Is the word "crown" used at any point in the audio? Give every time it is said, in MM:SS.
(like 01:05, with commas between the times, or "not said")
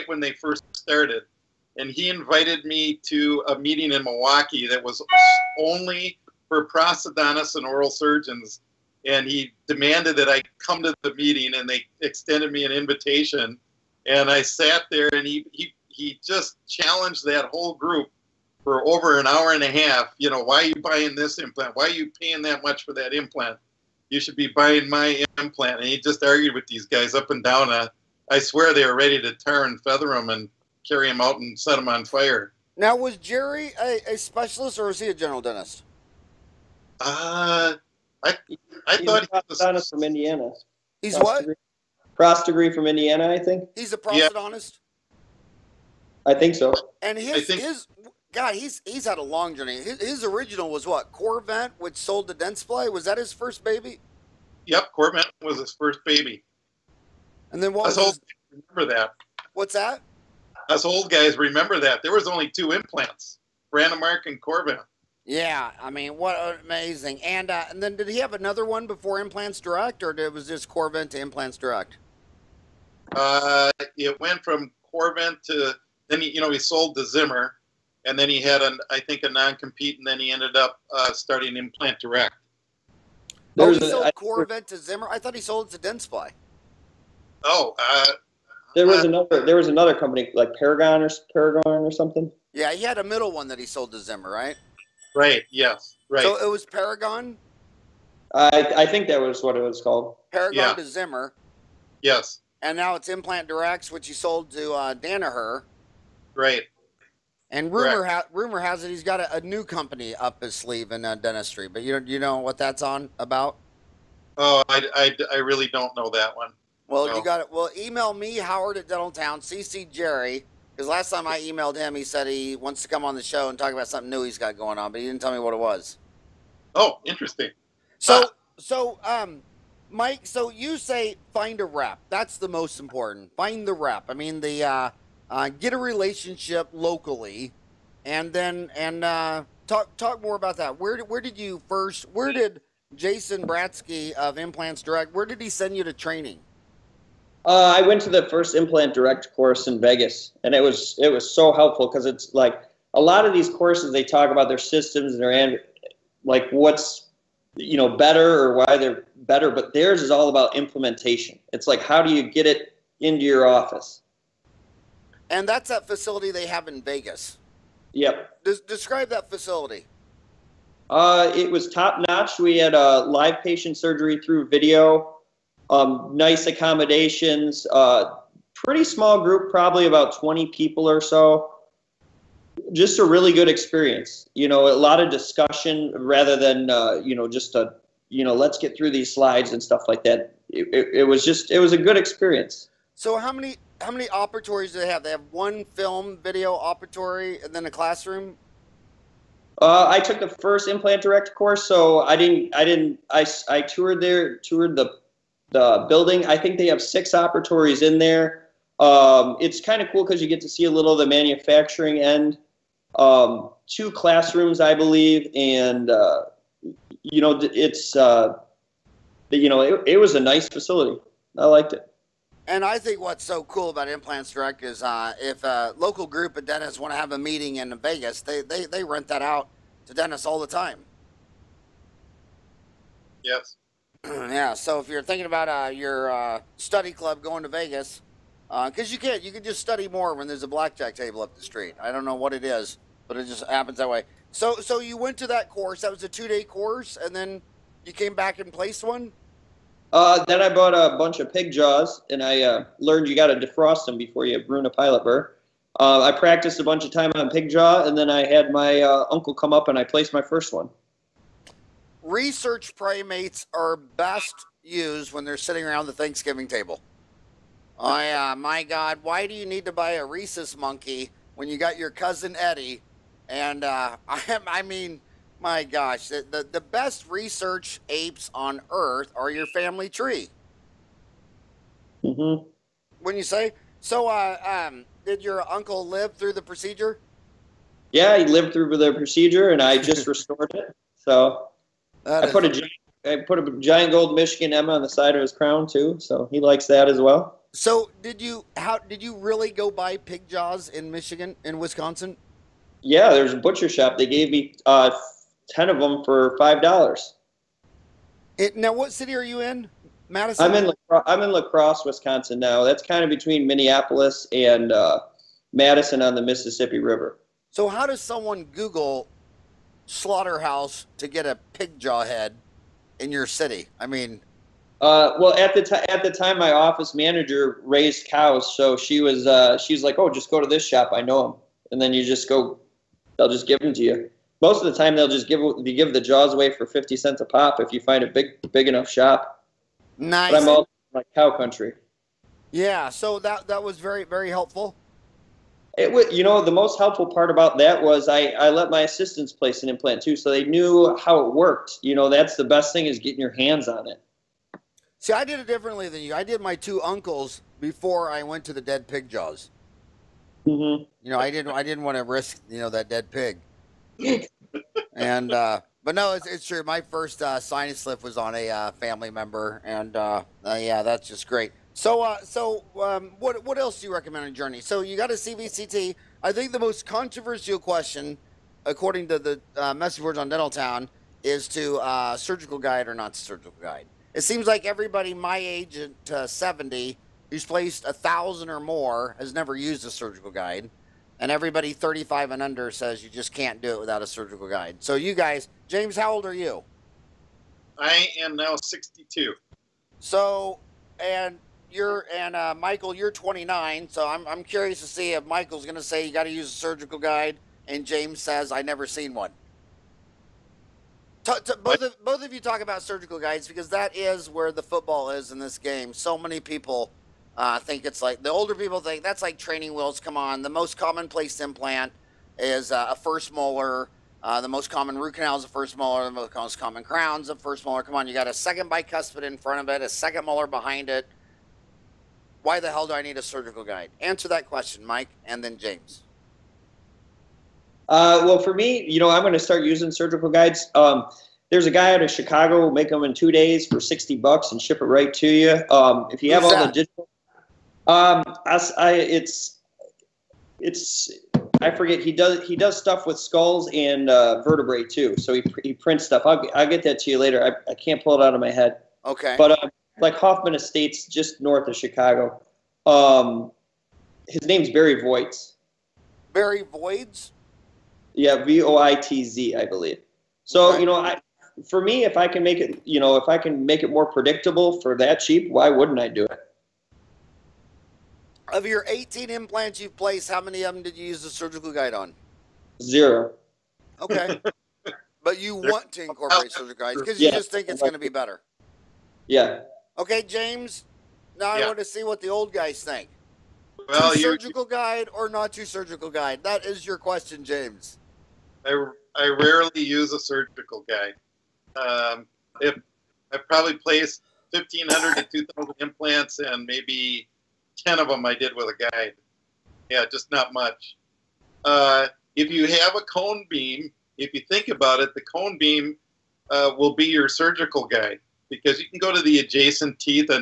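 04:55, 07:06.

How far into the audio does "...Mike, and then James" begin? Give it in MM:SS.
07:14.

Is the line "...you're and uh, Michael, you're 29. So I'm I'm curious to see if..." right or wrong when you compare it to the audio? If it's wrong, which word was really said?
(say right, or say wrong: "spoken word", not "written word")
right.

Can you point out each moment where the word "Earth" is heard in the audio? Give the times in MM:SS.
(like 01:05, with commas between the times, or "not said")
04:38.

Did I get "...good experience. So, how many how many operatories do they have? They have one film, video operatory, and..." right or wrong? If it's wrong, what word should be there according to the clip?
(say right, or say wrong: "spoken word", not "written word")
right.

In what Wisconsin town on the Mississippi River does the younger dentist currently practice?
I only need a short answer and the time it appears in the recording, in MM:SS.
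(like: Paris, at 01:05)
La Crosse, at 05:11.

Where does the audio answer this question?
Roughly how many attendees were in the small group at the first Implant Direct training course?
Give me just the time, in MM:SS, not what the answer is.
02:59.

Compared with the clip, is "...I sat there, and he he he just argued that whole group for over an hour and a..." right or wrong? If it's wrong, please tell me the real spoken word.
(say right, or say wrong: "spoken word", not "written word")
wrong: "challenged", not "argued".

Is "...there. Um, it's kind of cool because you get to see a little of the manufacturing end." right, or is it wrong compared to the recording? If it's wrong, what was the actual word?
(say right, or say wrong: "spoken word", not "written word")
right.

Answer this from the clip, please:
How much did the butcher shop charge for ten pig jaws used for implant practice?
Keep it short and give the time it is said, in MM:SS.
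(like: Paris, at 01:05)
$5, at 05:06.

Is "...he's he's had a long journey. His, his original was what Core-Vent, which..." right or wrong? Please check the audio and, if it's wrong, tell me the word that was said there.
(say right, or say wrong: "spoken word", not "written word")
right.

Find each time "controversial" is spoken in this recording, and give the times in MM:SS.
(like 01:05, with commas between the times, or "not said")
06:16.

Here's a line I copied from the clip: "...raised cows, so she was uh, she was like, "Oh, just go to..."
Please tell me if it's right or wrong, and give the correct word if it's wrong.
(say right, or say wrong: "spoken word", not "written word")
right.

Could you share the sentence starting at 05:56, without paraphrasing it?
I did my two uncles before I went to the dead pig jaws.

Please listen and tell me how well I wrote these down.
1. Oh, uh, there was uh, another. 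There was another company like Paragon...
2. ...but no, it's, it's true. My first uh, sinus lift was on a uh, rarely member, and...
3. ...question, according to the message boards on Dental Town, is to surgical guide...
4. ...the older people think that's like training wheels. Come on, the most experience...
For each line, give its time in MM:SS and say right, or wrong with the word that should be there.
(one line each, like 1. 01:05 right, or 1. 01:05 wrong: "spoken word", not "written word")
1. 01:27 right
2. 06:05 wrong: "family", not "rarely"
3. 06:17 right
4. 06:58 wrong: "commonplace", not "experience".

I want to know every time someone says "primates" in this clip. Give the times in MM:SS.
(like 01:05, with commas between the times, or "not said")
04:22.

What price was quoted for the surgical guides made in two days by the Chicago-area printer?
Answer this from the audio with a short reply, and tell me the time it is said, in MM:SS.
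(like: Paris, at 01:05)
$60, at 07:23.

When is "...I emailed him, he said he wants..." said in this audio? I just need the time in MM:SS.
02:01.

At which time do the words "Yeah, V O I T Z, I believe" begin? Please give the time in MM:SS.
07:48.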